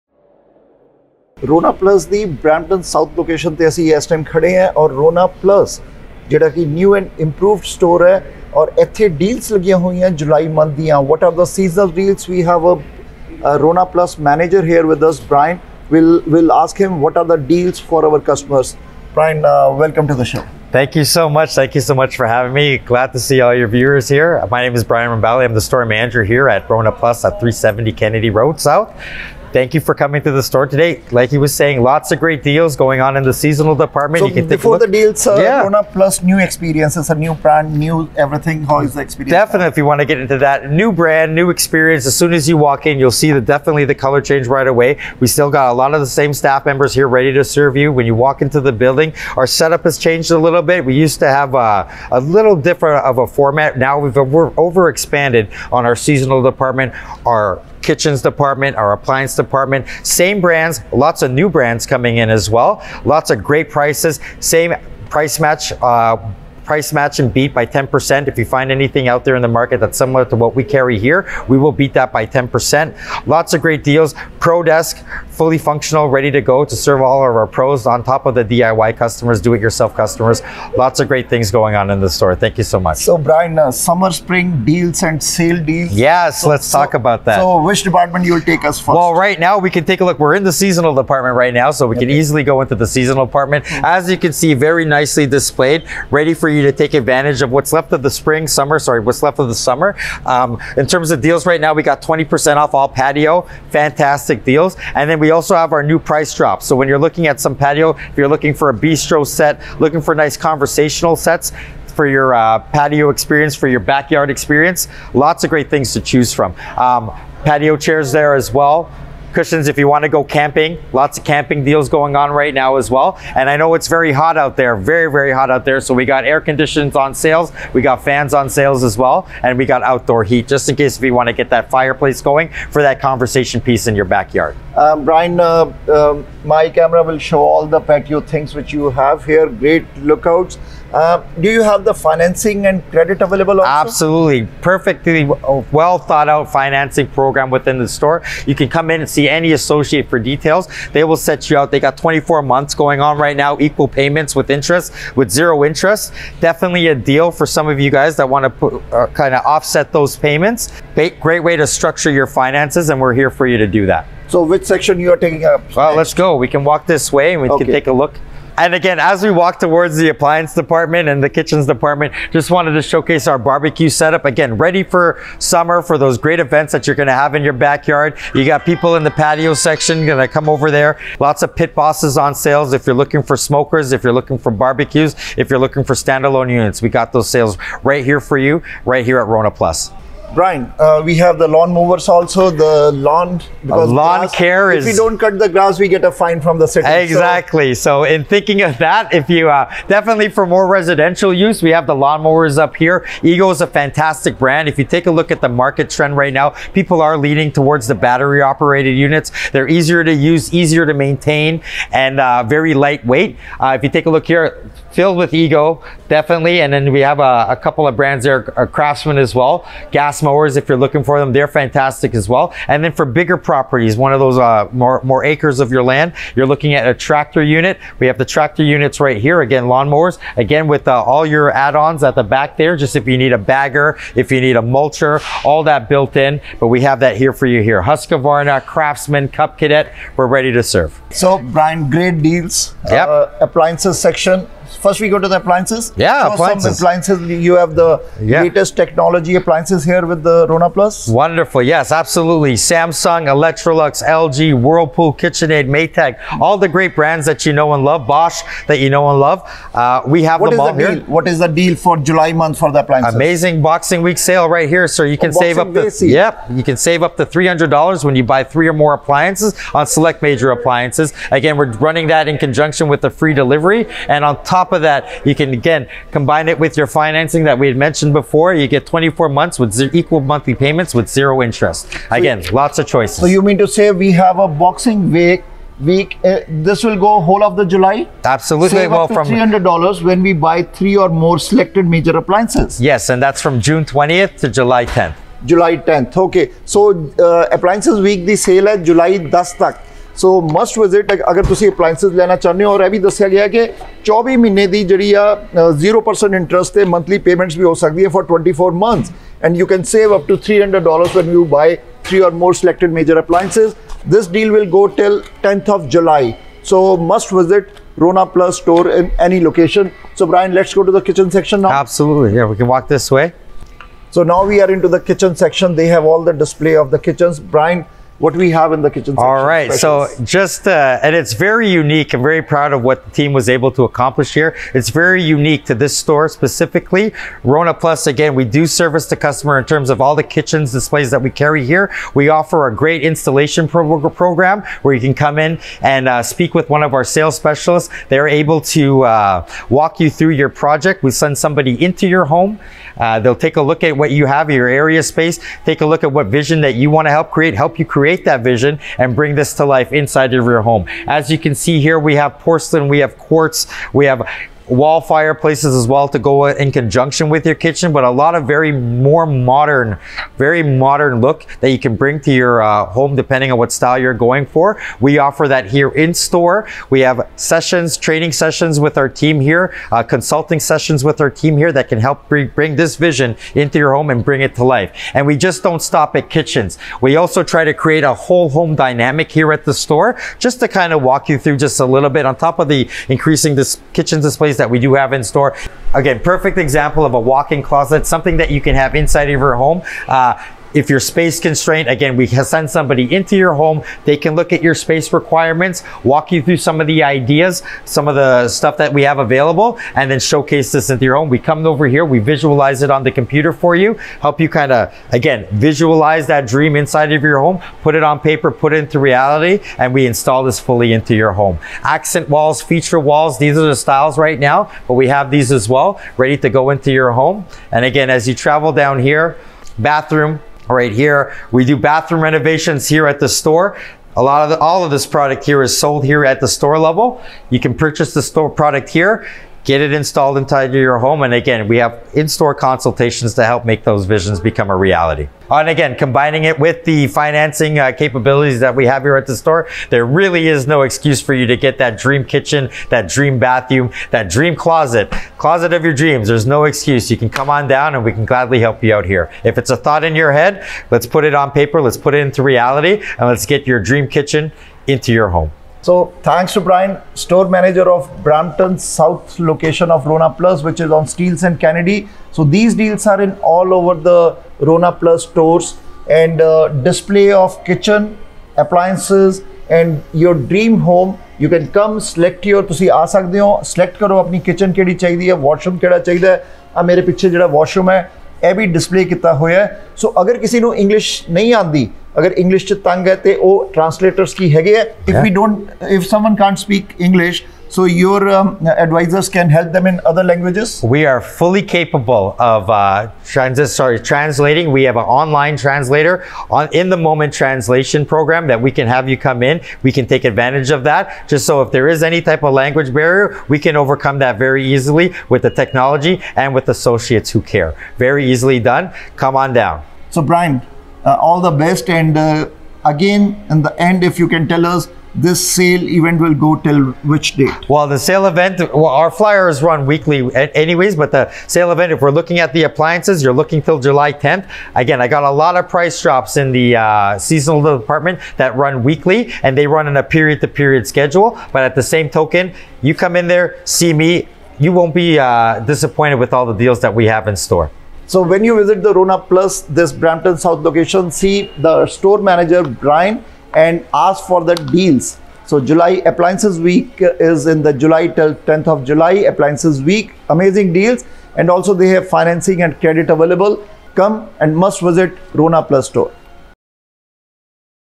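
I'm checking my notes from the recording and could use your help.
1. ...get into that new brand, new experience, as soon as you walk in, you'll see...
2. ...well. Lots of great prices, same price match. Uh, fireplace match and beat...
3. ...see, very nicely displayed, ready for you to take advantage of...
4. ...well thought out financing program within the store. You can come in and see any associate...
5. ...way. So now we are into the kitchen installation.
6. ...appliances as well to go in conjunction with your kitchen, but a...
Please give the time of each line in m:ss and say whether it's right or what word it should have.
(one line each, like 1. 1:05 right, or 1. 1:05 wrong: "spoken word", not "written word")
1. 0:40 right
2. 1:02 wrong: "price", not "fireplace"
3. 1:34 right
4. 2:25 right
5. 5:23 wrong: "section", not "installation"
6. 6:05 wrong: "fireplaces", not "appliances".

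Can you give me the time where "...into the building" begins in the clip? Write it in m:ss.
0:48.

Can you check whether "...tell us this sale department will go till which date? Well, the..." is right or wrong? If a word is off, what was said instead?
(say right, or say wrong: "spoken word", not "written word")
wrong: "event", not "department".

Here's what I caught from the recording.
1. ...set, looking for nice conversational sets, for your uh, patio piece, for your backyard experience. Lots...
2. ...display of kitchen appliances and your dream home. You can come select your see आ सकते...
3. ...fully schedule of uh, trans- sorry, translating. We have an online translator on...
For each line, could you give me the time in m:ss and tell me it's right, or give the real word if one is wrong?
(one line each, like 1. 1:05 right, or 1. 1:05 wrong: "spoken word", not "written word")
1. 1:49 wrong: "experience", not "piece"
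2. 7:56 right
3. 8:21 wrong: "capable", not "schedule".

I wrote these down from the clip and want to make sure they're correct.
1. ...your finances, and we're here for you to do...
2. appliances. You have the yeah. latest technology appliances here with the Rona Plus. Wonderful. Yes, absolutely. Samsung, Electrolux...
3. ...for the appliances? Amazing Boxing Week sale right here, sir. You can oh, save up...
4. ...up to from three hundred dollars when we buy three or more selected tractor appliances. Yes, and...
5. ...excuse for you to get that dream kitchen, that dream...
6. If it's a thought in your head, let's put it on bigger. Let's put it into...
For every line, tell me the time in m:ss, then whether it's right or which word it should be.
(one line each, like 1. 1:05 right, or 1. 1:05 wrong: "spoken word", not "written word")
1. 2:42 right
2. 4:06 right
3. 4:22 right
4. 4:49 wrong: "major", not "tractor"
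5. 7:30 right
6. 7:39 wrong: "paper", not "bigger".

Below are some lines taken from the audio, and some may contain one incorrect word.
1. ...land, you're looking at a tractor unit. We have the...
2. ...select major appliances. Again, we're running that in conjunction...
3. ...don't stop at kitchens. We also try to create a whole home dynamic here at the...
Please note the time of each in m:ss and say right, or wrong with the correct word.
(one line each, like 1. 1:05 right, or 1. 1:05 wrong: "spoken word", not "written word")
1. 3:45 right
2. 4:29 right
3. 6:25 right.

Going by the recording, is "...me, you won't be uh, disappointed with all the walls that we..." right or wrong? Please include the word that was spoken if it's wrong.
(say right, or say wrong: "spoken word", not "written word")
wrong: "deals", not "walls".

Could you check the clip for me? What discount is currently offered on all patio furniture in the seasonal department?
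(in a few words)
20%.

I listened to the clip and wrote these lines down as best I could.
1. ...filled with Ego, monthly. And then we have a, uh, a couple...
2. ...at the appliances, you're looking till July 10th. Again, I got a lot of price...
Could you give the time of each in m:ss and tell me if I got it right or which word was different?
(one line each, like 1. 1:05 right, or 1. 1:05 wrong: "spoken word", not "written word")
1. 3:34 wrong: "definitely", not "monthly"
2. 8:52 right.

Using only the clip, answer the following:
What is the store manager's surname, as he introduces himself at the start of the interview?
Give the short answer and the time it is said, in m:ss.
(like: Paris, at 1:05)
Rambali, at 0:25.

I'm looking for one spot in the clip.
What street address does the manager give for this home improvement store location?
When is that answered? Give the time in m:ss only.
0:27.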